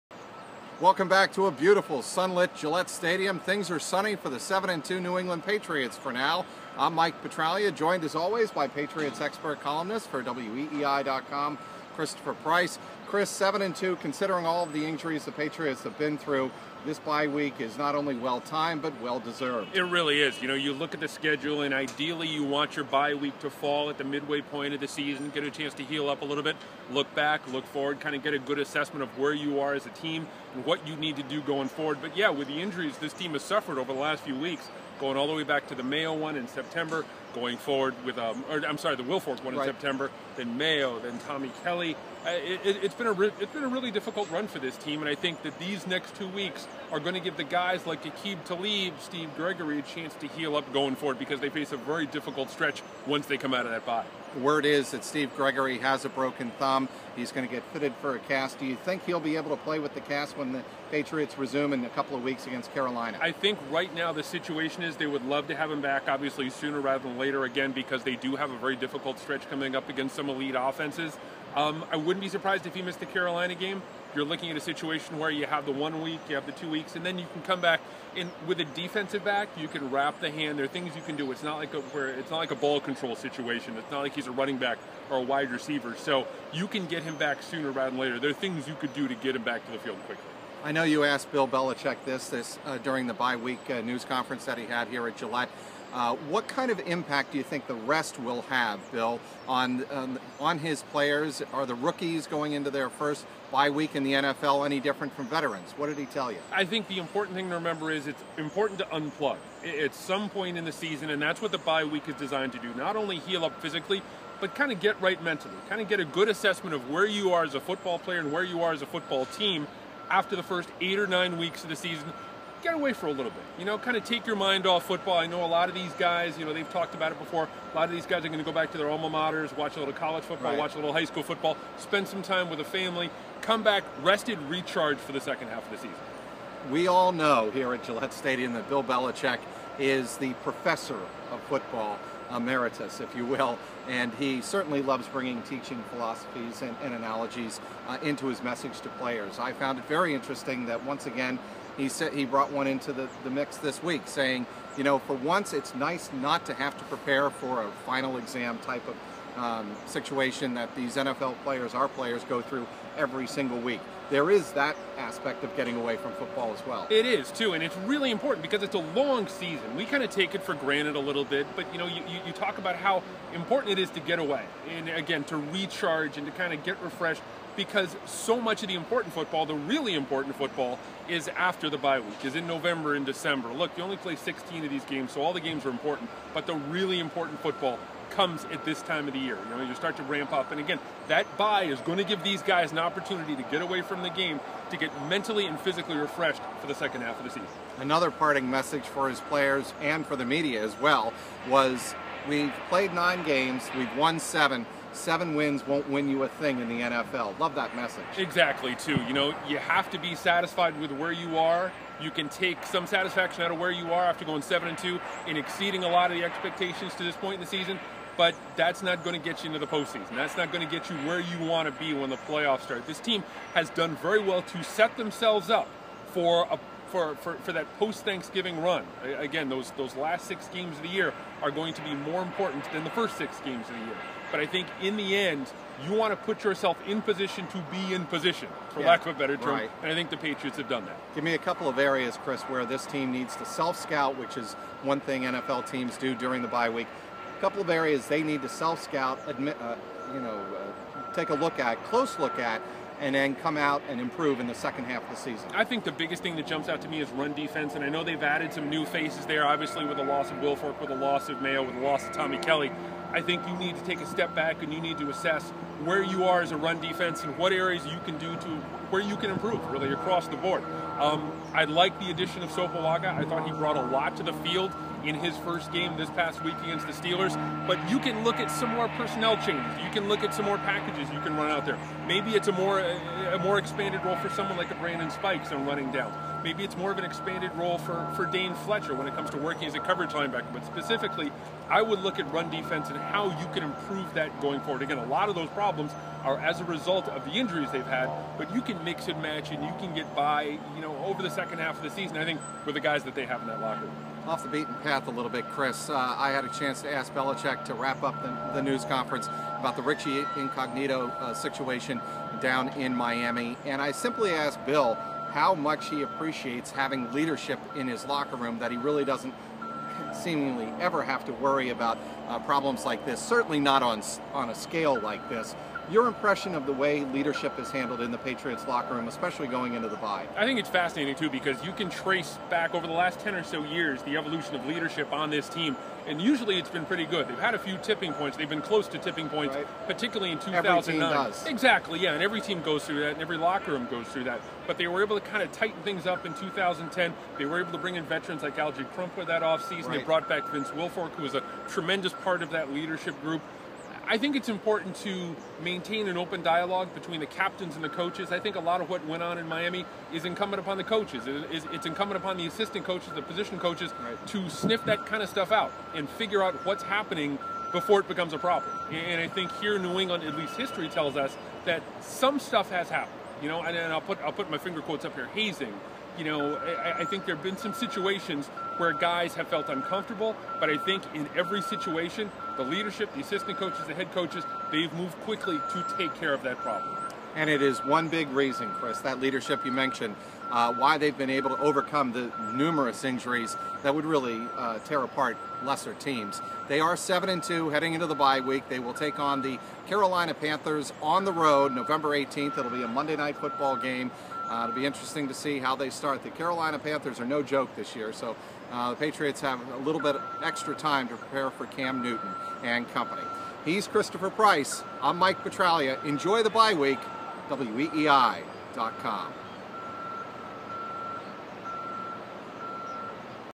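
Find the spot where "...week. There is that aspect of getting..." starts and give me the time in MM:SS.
02:43.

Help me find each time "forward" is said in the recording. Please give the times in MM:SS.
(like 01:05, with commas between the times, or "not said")
00:27, 00:31, 00:37, 00:50, 04:54.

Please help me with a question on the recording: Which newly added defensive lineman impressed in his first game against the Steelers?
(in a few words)
Sopalaga.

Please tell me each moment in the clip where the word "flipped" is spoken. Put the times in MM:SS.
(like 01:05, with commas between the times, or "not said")
not said.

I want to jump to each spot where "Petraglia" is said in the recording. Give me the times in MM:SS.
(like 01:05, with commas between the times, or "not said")
00:07, 06:55.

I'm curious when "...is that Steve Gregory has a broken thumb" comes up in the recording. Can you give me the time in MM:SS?
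00:54.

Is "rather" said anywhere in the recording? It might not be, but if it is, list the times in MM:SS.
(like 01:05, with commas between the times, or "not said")
01:06, 01:27.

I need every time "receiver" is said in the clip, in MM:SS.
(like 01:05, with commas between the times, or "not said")
01:25.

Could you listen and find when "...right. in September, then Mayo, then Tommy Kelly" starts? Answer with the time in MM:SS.
00:39.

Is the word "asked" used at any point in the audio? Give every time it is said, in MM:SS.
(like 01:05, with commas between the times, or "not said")
01:31, 05:14.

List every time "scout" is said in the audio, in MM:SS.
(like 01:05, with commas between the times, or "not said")
04:03, 04:08.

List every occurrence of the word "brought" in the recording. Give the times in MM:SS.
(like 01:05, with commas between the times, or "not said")
02:32, 04:33, 05:50.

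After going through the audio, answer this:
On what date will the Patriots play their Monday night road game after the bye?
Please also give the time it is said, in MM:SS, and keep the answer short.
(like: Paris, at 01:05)
November 18, at 06:41.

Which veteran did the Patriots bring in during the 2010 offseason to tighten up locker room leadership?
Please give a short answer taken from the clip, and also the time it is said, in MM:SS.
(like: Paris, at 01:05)
Alge Crumpler, at 05:48.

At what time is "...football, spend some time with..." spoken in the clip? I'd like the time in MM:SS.
02:11.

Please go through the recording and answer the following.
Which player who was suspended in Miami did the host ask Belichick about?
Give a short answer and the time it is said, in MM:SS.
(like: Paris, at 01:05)
Richie Incognito, at 05:09.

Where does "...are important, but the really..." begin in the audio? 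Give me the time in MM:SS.
03:05.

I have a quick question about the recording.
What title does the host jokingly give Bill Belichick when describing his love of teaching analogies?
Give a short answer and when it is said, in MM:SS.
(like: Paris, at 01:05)
professor of football emeritus, at 02:20.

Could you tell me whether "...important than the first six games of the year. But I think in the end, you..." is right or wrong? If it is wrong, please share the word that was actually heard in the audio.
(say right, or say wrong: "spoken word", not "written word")
right.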